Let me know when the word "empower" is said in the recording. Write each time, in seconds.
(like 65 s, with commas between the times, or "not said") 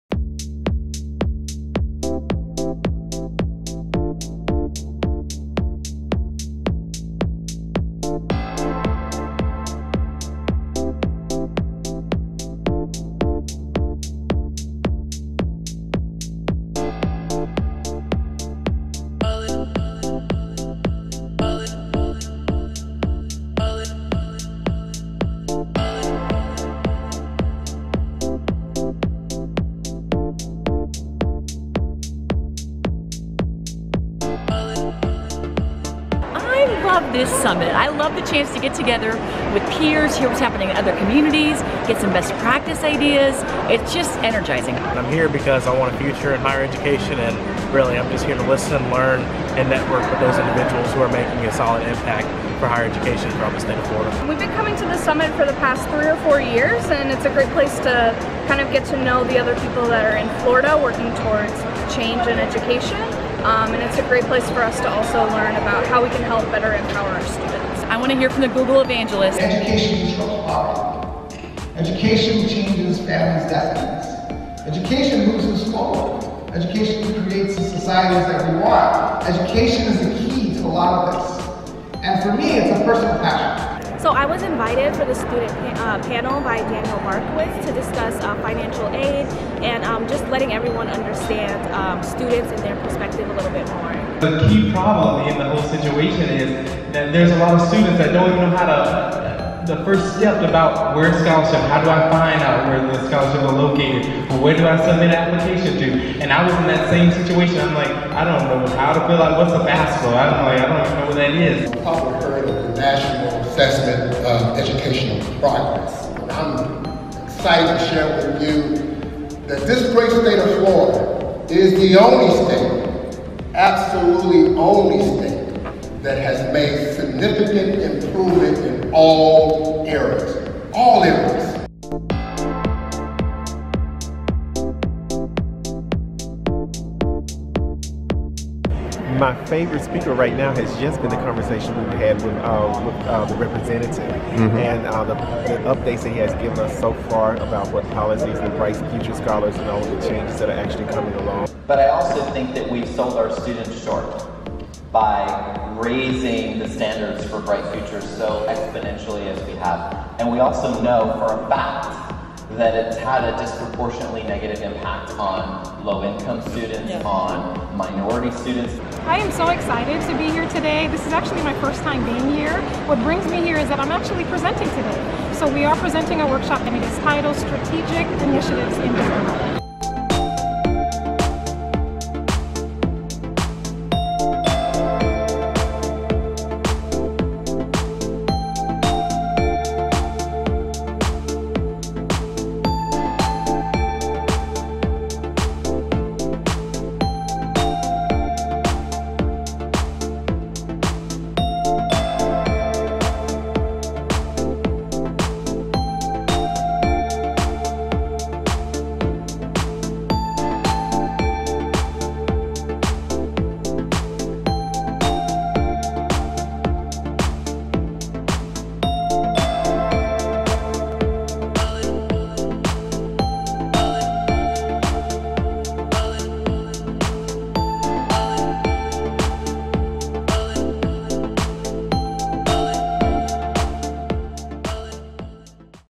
66 s.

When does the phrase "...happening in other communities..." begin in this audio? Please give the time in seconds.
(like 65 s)
40 s.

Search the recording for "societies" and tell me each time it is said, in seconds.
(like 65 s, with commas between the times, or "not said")
77 s.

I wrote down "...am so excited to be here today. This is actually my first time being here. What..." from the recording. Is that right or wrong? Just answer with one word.
right.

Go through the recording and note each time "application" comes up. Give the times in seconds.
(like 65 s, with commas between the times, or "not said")
105 s.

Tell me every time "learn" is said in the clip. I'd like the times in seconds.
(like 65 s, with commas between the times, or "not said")
48 s, 65 s.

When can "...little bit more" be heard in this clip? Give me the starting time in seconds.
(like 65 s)
93 s.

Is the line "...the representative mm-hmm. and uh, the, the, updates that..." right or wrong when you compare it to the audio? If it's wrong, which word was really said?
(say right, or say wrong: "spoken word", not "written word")
right.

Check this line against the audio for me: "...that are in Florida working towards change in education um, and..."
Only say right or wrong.
right.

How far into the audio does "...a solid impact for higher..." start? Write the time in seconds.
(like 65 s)
51 s.